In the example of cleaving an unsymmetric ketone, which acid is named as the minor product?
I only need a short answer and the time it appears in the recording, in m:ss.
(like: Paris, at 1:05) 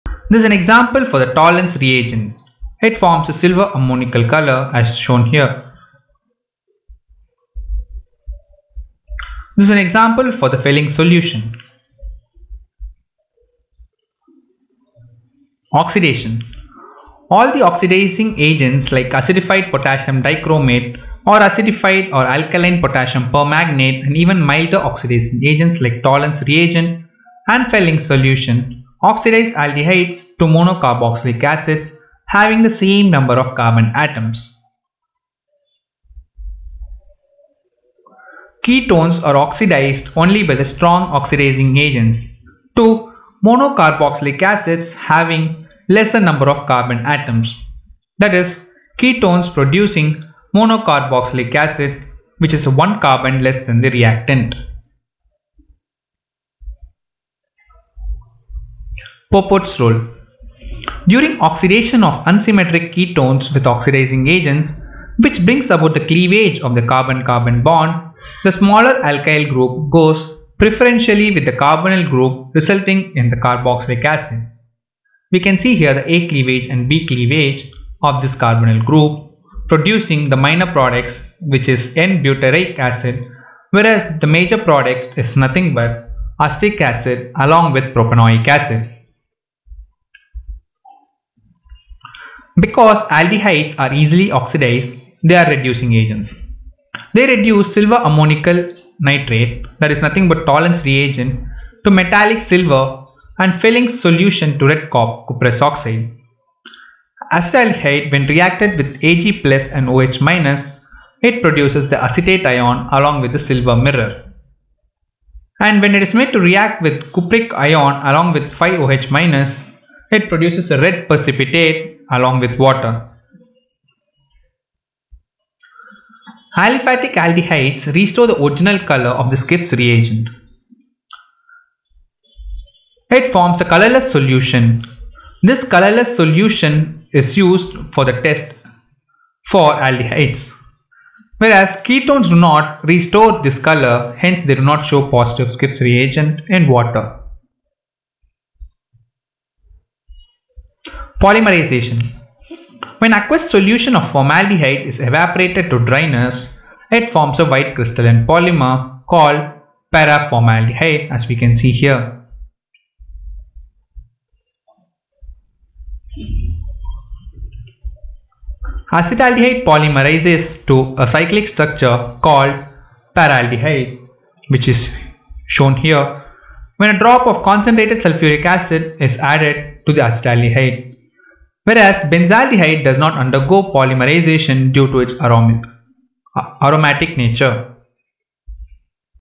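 n-butyric acid, at 1:21.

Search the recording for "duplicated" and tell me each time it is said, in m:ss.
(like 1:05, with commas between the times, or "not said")
not said.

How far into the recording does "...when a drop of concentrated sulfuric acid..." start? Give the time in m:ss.
2:56.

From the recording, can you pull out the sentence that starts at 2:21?
Whereas ketones do not restore this color, hence they do not show positive Schiff's reagent in water.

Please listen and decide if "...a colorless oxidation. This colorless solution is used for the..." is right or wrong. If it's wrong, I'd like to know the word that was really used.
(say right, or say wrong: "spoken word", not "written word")
wrong: "solution", not "oxidation".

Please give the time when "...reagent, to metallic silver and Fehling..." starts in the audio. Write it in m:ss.
1:40.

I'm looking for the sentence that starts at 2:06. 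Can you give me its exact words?
Aliphatic aldehydes restore the original color of the Schiff's reagent.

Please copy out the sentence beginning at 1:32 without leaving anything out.
Because aldehydes are easily oxidized, they are reducing agents.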